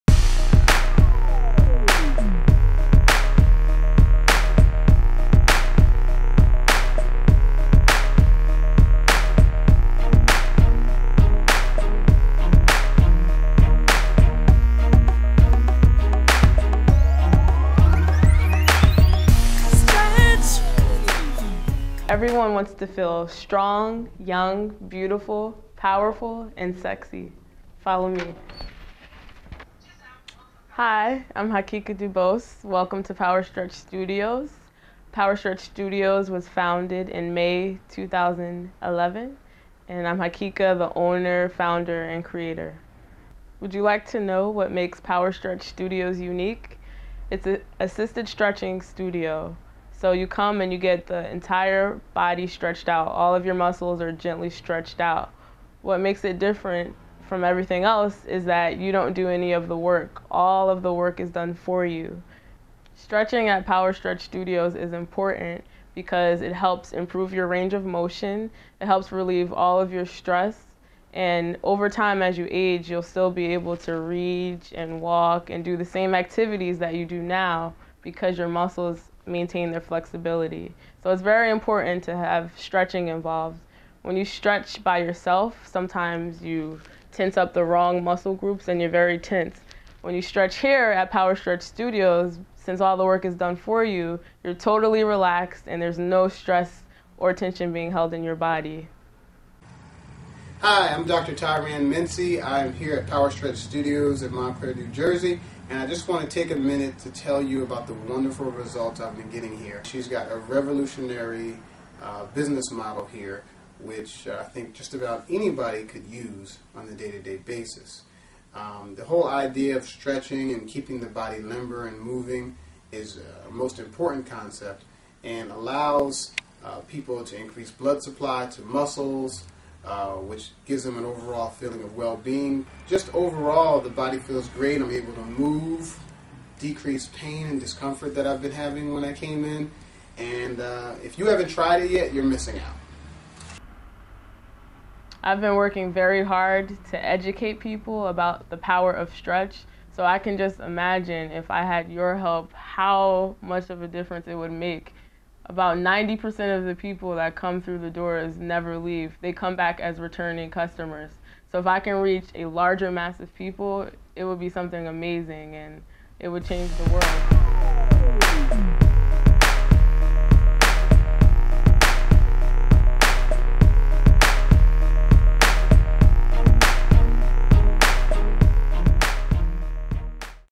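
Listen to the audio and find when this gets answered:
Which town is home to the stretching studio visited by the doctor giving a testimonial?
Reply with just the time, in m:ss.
1:44.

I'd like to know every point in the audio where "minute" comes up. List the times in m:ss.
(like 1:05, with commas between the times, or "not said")
1:46.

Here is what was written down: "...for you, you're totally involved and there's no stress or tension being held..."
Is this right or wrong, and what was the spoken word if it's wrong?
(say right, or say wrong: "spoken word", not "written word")
wrong: "relaxed", not "involved".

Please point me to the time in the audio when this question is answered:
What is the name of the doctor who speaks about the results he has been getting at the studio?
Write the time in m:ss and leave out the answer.
1:41.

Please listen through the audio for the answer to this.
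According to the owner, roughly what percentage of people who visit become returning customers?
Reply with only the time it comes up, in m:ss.
2:35.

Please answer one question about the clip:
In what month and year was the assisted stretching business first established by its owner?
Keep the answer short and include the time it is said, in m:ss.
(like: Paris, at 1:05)
May 2011, at 0:37.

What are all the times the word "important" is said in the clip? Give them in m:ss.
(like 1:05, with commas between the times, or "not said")
1:04, 1:21, 2:03.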